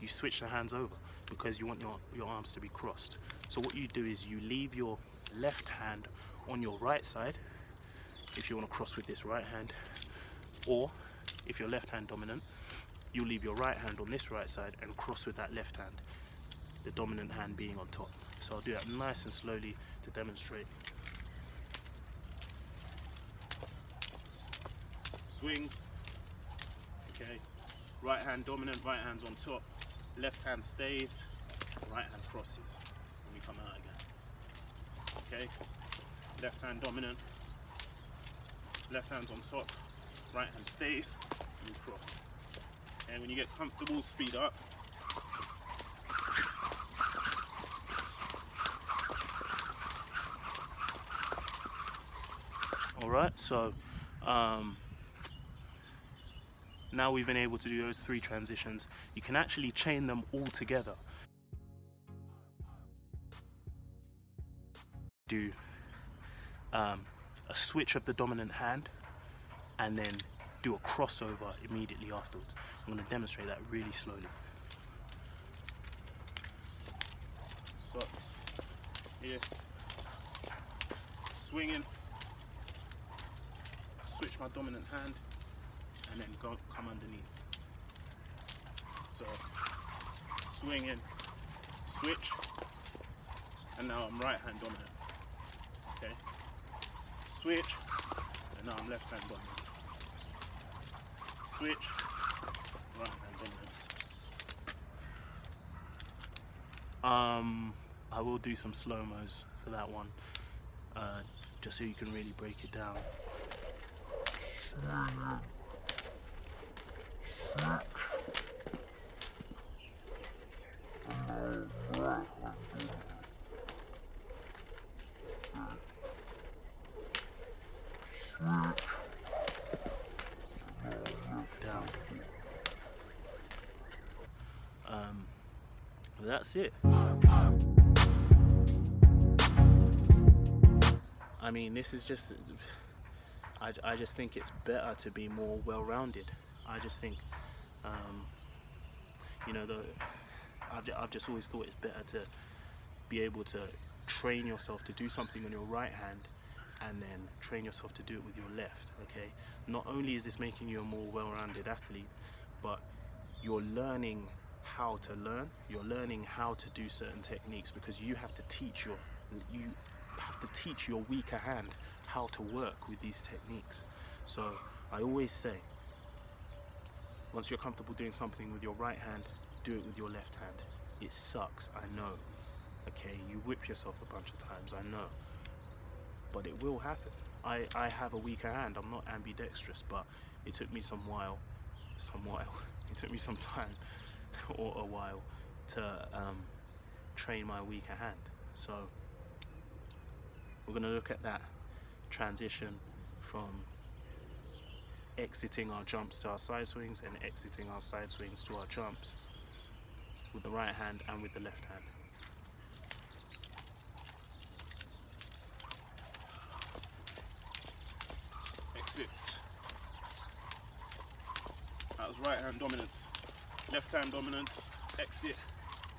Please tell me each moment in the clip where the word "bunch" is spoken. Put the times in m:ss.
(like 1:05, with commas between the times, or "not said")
3:04.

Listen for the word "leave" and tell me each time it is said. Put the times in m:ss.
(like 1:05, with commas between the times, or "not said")
0:04, 0:13.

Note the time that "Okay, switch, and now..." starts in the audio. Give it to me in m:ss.
1:36.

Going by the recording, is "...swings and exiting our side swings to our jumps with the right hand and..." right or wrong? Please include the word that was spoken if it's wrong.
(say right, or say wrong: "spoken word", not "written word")
right.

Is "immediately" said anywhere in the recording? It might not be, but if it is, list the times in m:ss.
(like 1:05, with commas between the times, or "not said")
1:11.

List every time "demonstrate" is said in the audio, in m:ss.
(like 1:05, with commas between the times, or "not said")
0:20, 1:13.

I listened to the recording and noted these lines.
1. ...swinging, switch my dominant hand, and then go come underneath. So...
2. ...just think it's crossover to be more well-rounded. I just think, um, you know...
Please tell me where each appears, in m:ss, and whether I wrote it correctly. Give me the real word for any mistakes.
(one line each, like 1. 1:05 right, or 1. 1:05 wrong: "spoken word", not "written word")
1. 1:21 right
2. 2:23 wrong: "better", not "crossover".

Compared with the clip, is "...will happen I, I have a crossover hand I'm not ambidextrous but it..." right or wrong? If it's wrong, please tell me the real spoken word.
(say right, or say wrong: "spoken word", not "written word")
wrong: "weaker", not "crossover".